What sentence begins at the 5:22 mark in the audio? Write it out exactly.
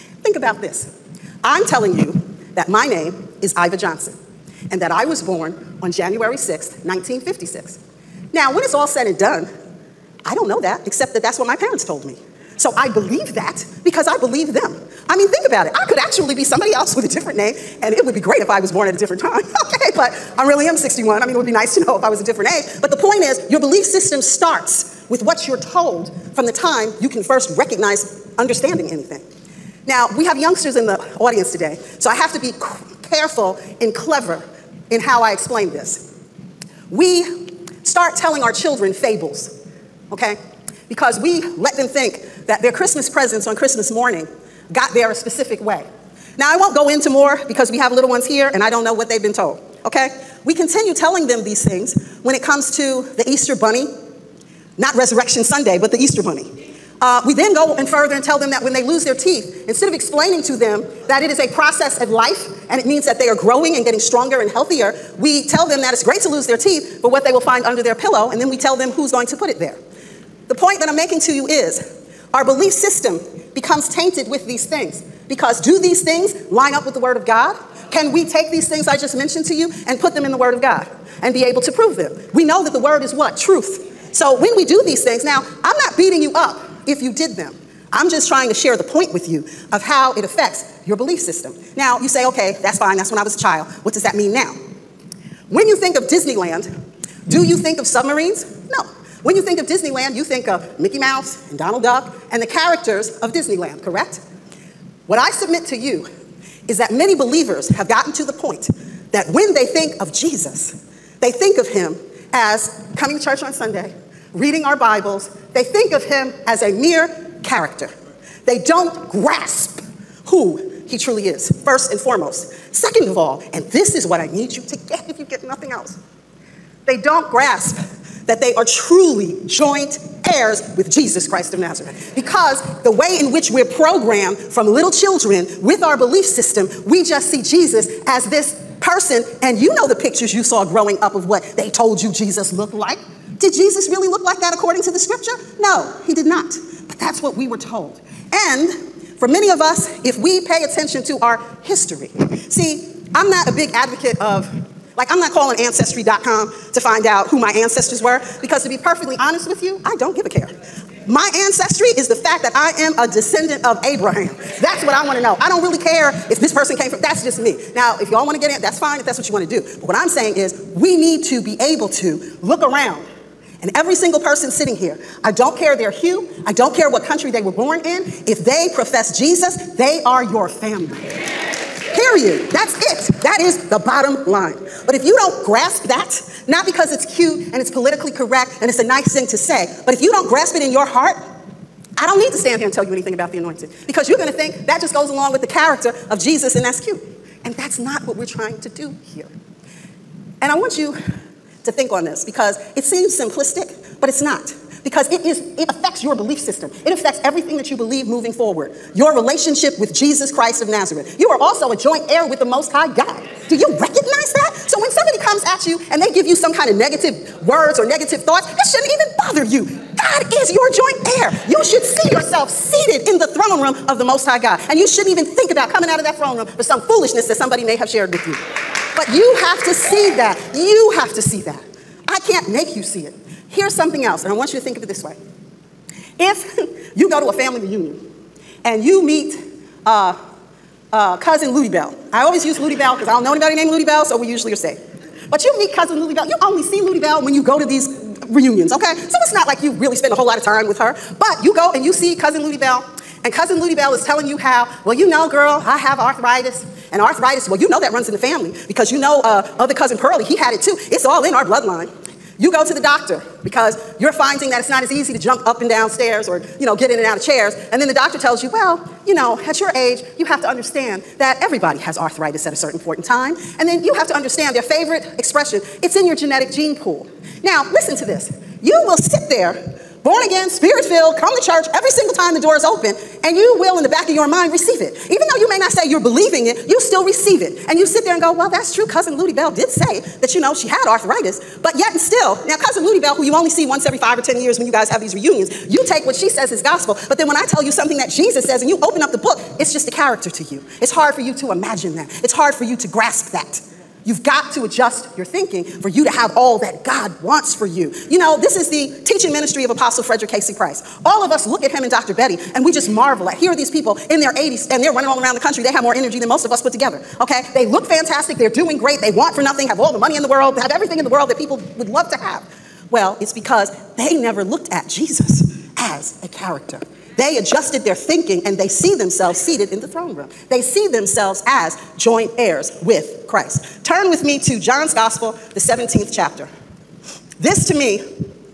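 Well, it's because they never looked at Jesus as a character.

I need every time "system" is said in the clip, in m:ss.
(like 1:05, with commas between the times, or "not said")
0:23, 1:12, 1:31, 2:16, 3:26.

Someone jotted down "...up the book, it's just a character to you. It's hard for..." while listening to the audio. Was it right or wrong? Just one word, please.
right.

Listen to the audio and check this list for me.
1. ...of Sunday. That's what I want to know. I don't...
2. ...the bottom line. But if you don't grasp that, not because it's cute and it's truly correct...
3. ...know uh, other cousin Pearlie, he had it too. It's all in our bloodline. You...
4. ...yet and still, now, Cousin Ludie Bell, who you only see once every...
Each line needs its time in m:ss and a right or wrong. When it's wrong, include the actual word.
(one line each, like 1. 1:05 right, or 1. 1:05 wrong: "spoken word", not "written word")
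1. 2:43 wrong: "Abraham", not "Sunday"
2. 3:03 wrong: "politically", not "truly"
3. 4:19 right
4. 4:51 right.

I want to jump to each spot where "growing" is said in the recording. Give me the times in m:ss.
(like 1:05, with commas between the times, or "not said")
1:03, 2:20.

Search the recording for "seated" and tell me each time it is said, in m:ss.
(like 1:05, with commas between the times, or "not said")
3:42, 5:29.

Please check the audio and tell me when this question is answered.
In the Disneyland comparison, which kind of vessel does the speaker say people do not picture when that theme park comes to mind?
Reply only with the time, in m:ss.
1:37.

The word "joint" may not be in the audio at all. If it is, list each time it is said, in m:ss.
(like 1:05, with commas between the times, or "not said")
2:09, 3:31, 3:40, 5:31.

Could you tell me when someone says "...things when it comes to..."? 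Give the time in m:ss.
0:51.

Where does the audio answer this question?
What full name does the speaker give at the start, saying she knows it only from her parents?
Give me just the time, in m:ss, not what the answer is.
0:03.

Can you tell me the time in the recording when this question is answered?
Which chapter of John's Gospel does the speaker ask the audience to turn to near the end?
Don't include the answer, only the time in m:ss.
5:35.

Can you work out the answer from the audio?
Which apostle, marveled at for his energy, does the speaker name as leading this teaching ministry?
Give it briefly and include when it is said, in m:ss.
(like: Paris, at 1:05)
Frederick K.C. Price, at 5:10.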